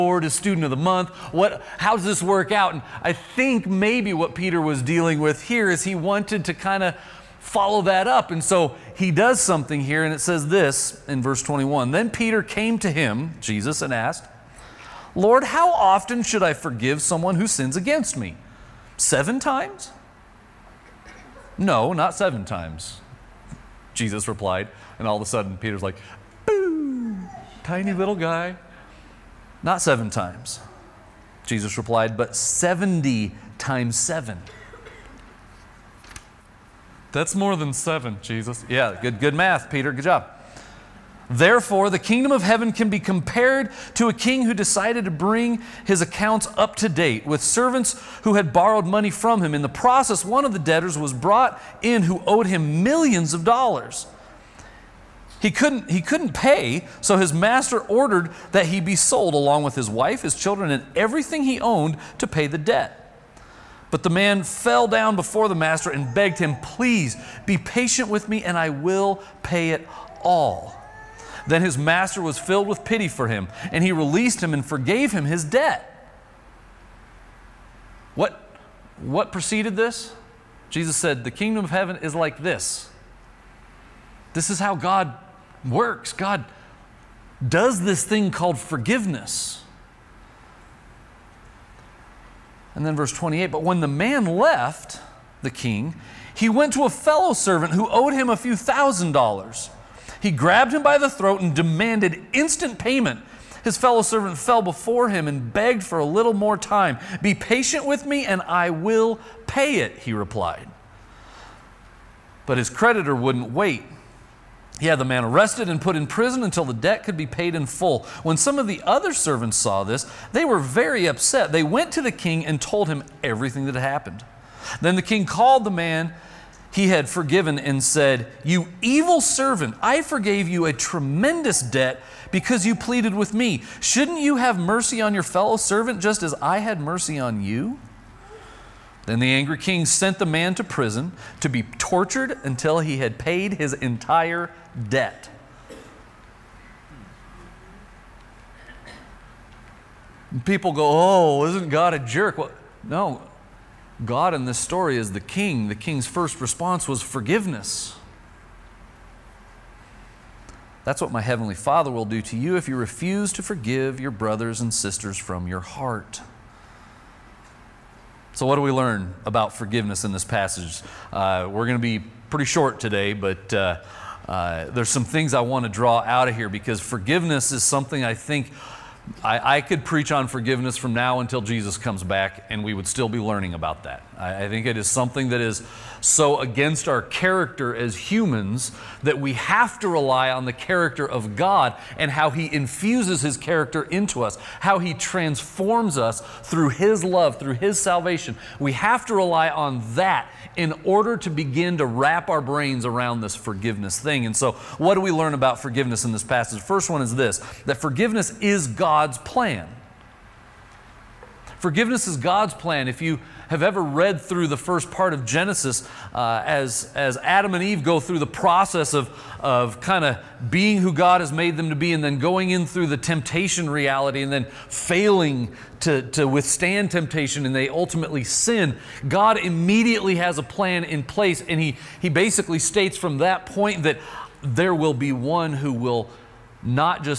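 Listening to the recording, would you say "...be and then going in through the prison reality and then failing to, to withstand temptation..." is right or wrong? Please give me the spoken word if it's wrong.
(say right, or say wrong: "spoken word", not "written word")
wrong: "temptation", not "prison".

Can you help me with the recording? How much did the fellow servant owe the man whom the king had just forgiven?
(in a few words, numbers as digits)
a few thousand dollars.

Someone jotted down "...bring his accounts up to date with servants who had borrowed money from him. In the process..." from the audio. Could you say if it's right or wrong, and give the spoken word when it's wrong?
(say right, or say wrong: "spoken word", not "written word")
right.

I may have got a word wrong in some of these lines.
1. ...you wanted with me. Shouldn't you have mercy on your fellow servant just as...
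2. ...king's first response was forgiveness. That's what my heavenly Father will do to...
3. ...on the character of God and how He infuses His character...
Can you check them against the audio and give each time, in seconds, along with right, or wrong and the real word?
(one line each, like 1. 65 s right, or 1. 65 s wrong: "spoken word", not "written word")
1. 132 s wrong: "pleaded", not "wanted"
2. 155 s right
3. 190 s right.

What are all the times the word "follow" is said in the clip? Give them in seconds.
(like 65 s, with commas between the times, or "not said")
7 s.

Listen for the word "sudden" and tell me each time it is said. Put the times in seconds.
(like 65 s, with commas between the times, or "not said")
25 s.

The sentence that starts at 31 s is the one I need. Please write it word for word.
Jesus replied, but 70 times seven.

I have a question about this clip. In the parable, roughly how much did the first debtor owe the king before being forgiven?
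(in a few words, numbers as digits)
millions of dollars.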